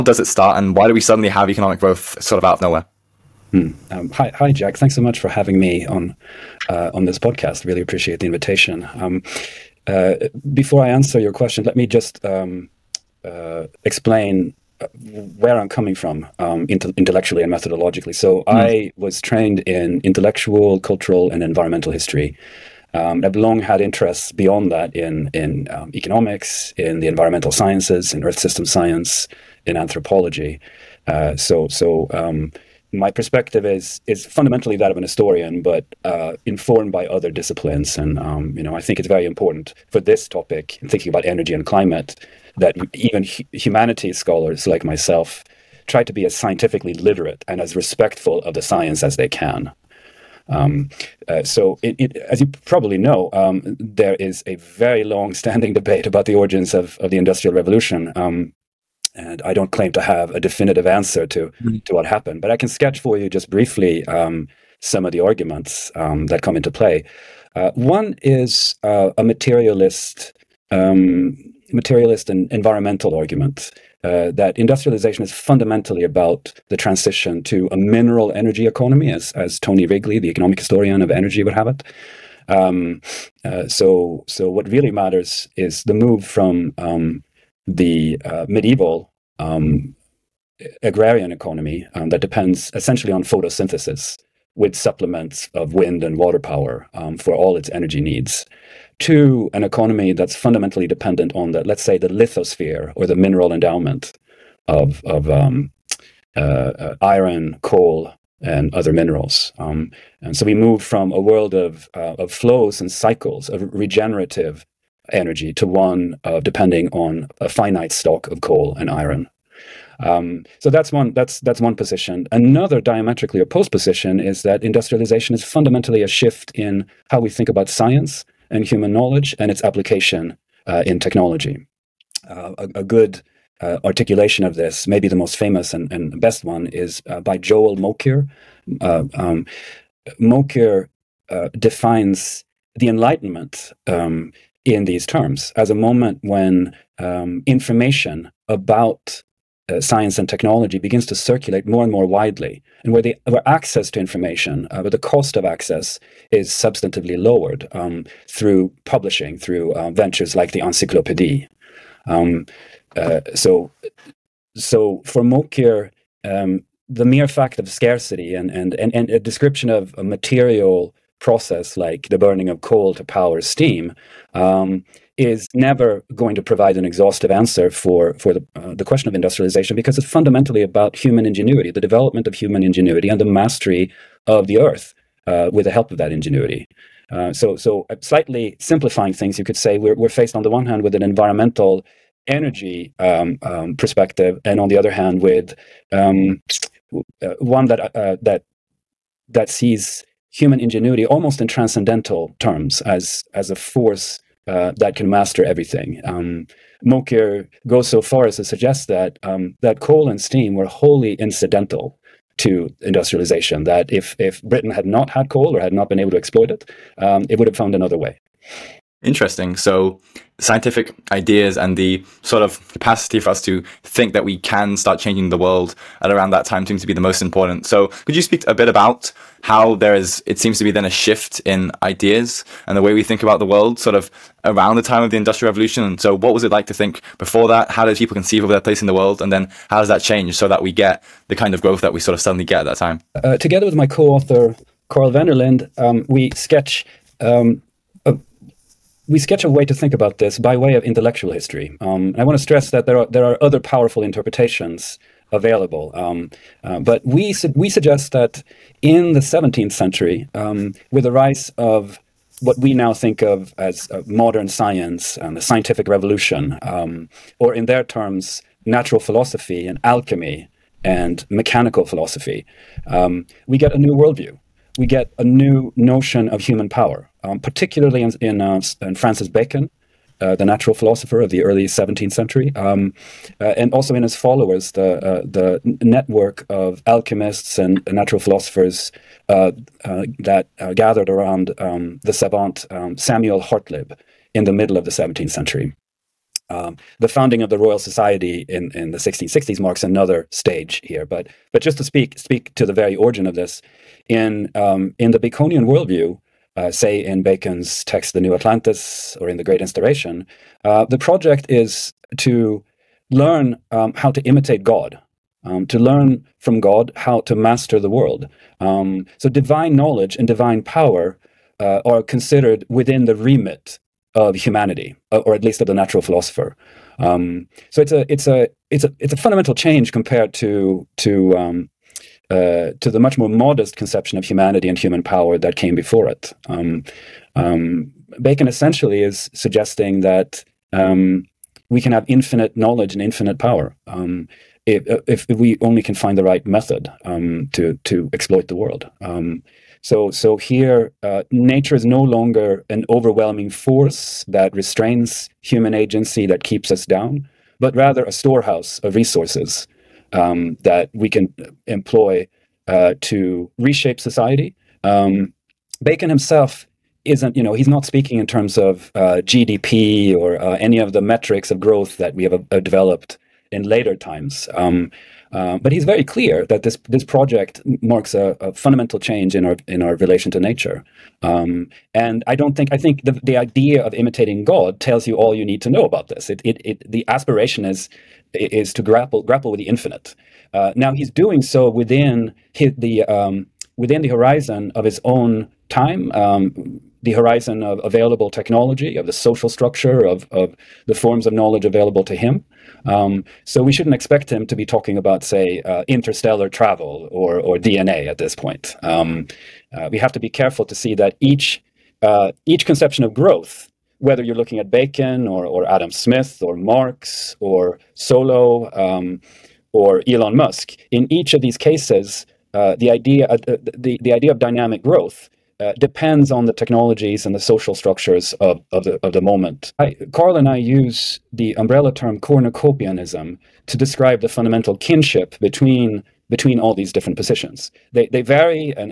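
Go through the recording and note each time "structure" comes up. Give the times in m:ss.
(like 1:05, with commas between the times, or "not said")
6:39, 7:07.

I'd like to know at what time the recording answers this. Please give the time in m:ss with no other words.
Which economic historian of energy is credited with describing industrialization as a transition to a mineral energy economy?
1:19.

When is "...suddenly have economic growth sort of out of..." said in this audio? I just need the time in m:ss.
0:00.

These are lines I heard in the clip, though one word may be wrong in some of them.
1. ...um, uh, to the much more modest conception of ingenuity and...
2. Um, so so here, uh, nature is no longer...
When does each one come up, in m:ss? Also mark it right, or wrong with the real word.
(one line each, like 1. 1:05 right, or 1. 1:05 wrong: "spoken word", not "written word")
1. 5:31 wrong: "humanity", not "ingenuity"
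2. 5:49 right.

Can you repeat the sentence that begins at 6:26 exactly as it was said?
It it it the aspiration is is to grapple grapple with the infinite.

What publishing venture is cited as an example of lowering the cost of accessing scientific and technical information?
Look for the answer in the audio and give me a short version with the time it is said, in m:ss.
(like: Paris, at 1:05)
the Encyclopédie, at 2:40.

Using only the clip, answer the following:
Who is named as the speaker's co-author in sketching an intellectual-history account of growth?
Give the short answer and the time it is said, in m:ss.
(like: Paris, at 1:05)
Carl Wennerlind, at 4:04.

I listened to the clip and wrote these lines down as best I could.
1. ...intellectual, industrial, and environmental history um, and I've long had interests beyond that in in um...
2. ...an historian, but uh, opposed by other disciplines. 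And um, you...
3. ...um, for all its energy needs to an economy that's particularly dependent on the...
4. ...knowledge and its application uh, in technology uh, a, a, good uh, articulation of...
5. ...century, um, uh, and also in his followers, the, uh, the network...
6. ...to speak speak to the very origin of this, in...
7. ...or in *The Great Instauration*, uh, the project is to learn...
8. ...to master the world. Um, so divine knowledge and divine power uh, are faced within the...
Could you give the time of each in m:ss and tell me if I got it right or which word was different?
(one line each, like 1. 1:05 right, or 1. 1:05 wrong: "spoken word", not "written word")
1. 0:20 wrong: "cultural", not "industrial"
2. 0:34 wrong: "informed", not "opposed"
3. 1:36 wrong: "fundamentally", not "particularly"
4. 2:08 right
5. 4:42 right
6. 5:01 right
7. 5:09 right
8. 5:17 wrong: "considered", not "faced".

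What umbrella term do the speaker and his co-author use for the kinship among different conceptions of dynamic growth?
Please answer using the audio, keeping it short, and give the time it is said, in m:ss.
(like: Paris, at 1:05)
cornucopianism, at 7:12.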